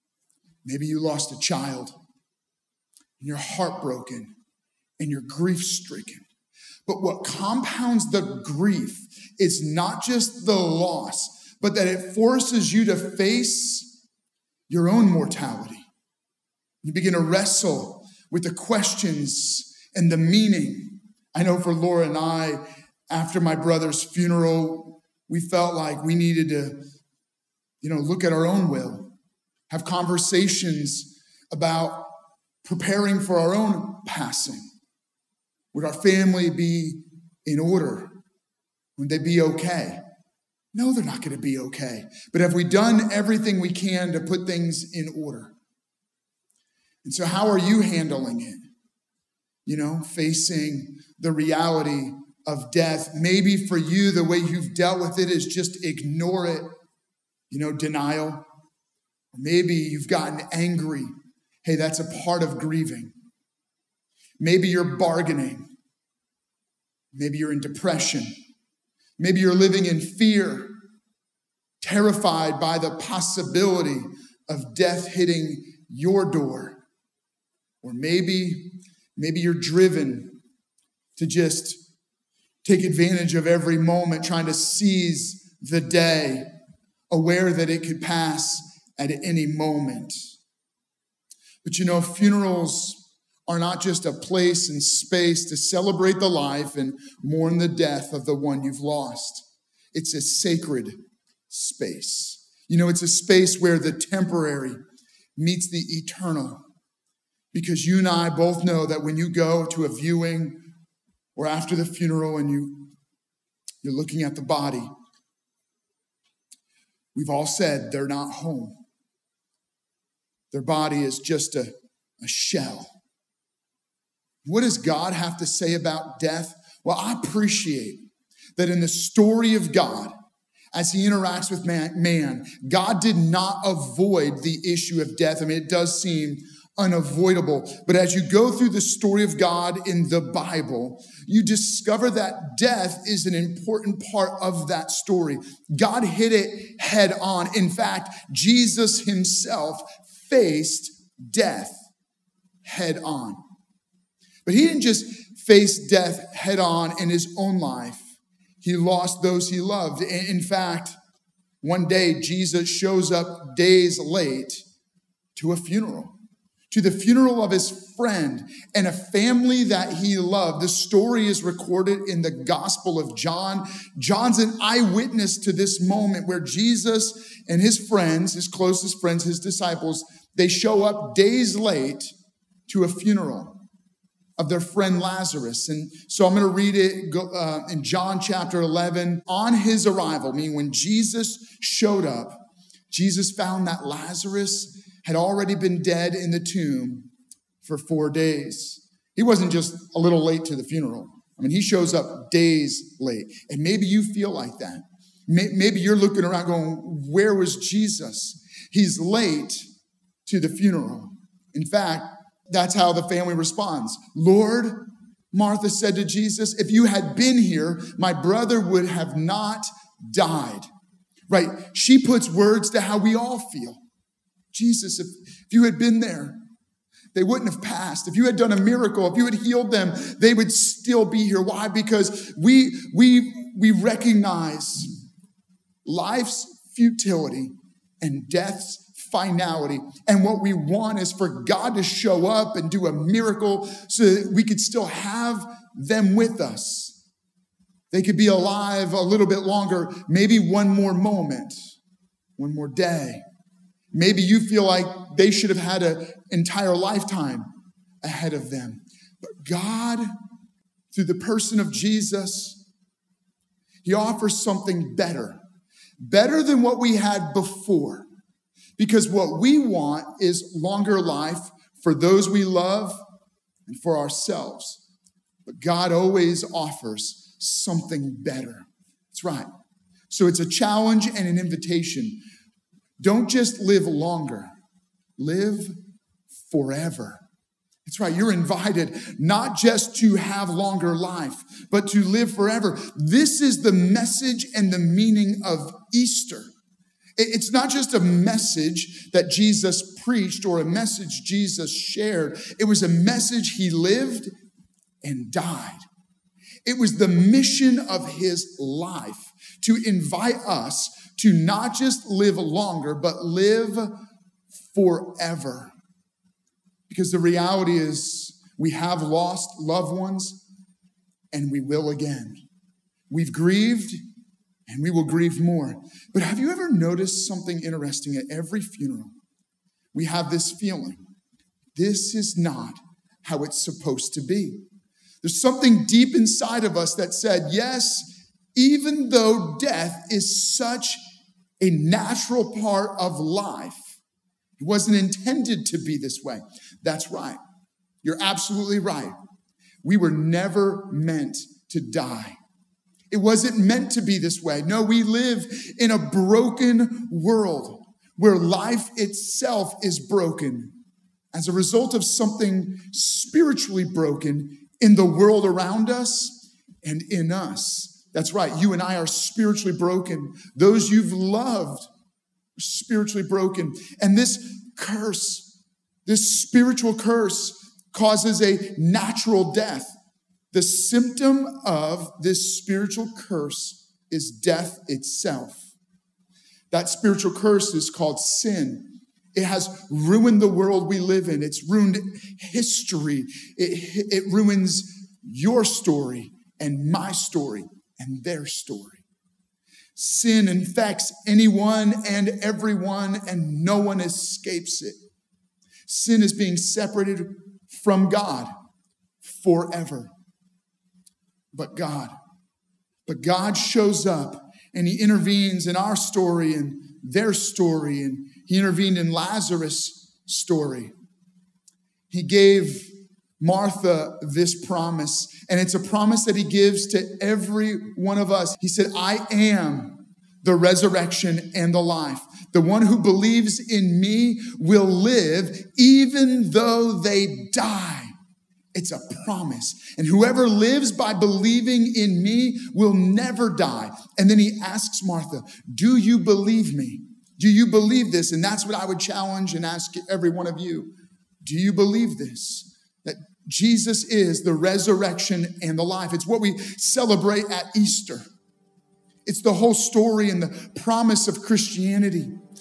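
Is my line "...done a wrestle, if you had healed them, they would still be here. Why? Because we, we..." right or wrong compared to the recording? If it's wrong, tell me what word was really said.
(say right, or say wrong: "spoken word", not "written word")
wrong: "miracle", not "wrestle".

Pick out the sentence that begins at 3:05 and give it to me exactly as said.
And so I'm going to read it uh, in John chapter 11.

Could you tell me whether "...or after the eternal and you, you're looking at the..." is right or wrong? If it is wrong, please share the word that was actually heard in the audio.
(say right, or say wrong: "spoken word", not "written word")
wrong: "funeral", not "eternal".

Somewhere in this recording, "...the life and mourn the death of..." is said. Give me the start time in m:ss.
1:36.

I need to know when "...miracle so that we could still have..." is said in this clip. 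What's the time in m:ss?
4:02.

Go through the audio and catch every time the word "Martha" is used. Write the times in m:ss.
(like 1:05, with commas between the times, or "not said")
3:35, 7:03, 7:25.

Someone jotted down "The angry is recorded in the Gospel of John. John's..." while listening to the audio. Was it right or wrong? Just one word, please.
wrong.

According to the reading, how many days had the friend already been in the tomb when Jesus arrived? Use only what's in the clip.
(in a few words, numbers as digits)
4.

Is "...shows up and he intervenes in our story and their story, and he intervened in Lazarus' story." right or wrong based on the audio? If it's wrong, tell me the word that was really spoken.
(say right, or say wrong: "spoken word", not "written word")
right.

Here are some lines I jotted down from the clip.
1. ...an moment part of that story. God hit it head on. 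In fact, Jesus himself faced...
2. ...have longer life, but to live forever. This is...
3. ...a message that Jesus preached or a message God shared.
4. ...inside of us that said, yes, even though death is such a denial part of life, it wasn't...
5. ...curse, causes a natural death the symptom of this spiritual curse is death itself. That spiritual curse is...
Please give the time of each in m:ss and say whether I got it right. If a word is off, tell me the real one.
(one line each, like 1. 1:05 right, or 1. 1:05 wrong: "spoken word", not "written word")
1. 2:23 wrong: "important", not "moment"
2. 4:50 right
3. 4:57 wrong: "Jesus", not "God"
4. 5:36 wrong: "natural", not "denial"
5. 6:16 right.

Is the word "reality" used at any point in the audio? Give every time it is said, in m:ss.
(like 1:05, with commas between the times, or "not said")
0:51, 5:17.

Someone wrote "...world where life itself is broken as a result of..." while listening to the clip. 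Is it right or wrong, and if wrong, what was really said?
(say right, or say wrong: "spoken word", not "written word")
right.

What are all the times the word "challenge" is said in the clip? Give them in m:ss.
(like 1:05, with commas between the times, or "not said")
4:40, 7:28.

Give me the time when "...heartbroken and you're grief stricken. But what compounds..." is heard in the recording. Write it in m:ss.
0:03.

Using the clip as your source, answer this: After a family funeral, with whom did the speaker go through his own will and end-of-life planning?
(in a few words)
Laura.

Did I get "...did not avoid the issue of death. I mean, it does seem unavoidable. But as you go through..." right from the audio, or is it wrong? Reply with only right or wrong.
right.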